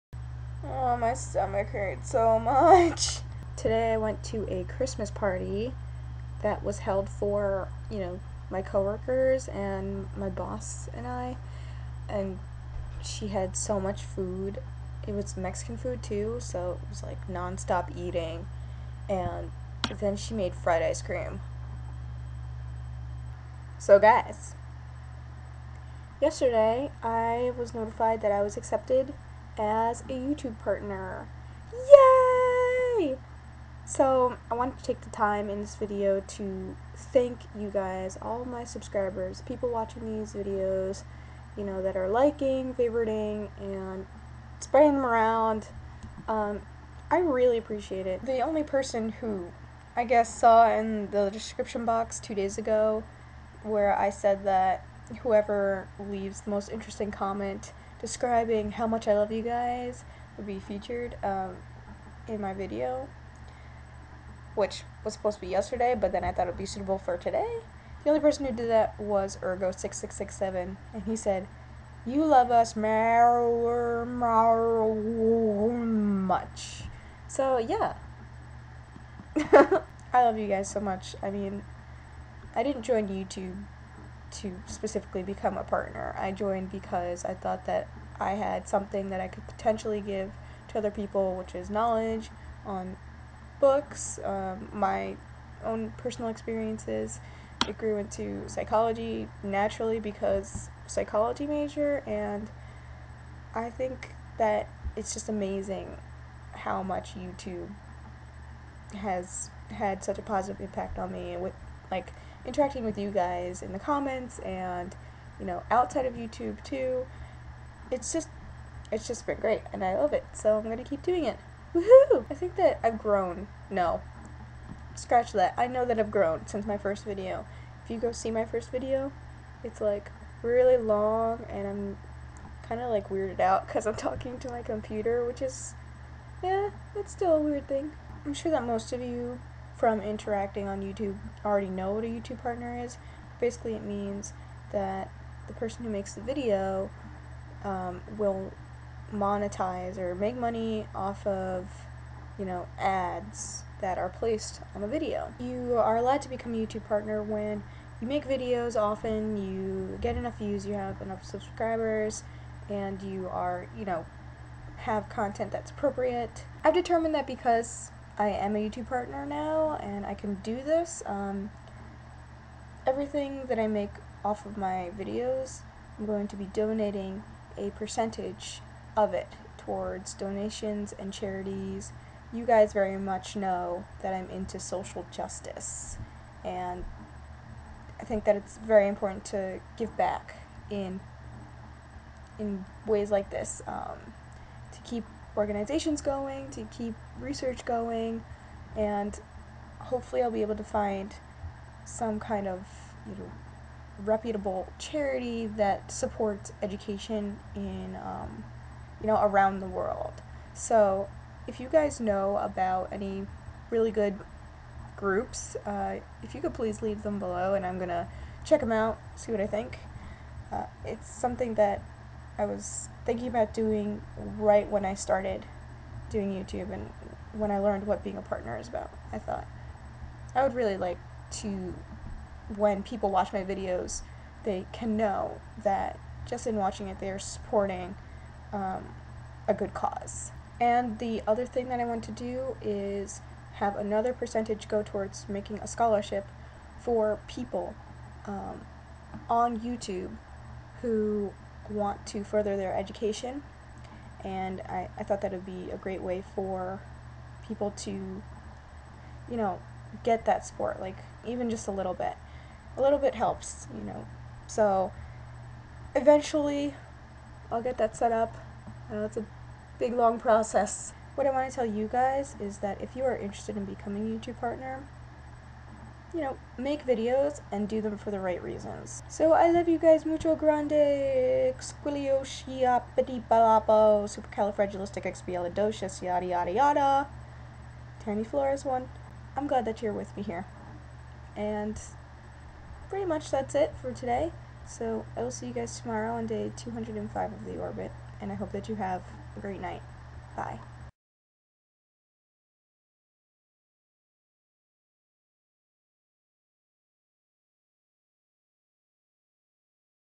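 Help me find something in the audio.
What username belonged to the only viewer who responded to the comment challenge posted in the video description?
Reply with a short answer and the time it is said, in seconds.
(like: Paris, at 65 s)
Urgo6667, at 69 s.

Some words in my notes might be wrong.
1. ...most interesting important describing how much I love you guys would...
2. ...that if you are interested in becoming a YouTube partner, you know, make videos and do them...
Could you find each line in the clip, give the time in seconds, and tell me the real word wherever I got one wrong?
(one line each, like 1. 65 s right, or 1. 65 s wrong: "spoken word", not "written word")
1. 56 s wrong: "comment", not "important"
2. 272 s right.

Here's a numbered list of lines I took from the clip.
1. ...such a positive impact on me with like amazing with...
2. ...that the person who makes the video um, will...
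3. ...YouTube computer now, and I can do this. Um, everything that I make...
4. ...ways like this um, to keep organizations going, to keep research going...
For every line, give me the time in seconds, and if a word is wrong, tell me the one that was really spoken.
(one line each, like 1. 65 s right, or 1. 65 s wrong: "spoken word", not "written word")
1. 110 s wrong: "interacting", not "amazing"
2. 144 s right
3. 168 s wrong: "partner", not "computer"
4. 192 s right.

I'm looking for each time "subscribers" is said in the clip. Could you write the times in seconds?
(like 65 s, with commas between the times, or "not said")
38 s, 161 s.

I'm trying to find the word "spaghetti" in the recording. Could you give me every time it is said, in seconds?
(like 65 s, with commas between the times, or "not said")
not said.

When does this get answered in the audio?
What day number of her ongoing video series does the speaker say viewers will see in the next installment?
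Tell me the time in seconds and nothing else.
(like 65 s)
296 s.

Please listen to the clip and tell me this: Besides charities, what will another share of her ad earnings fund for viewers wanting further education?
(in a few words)
a scholarship.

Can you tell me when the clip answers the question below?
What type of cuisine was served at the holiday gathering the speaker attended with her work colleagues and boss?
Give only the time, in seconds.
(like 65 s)
15 s.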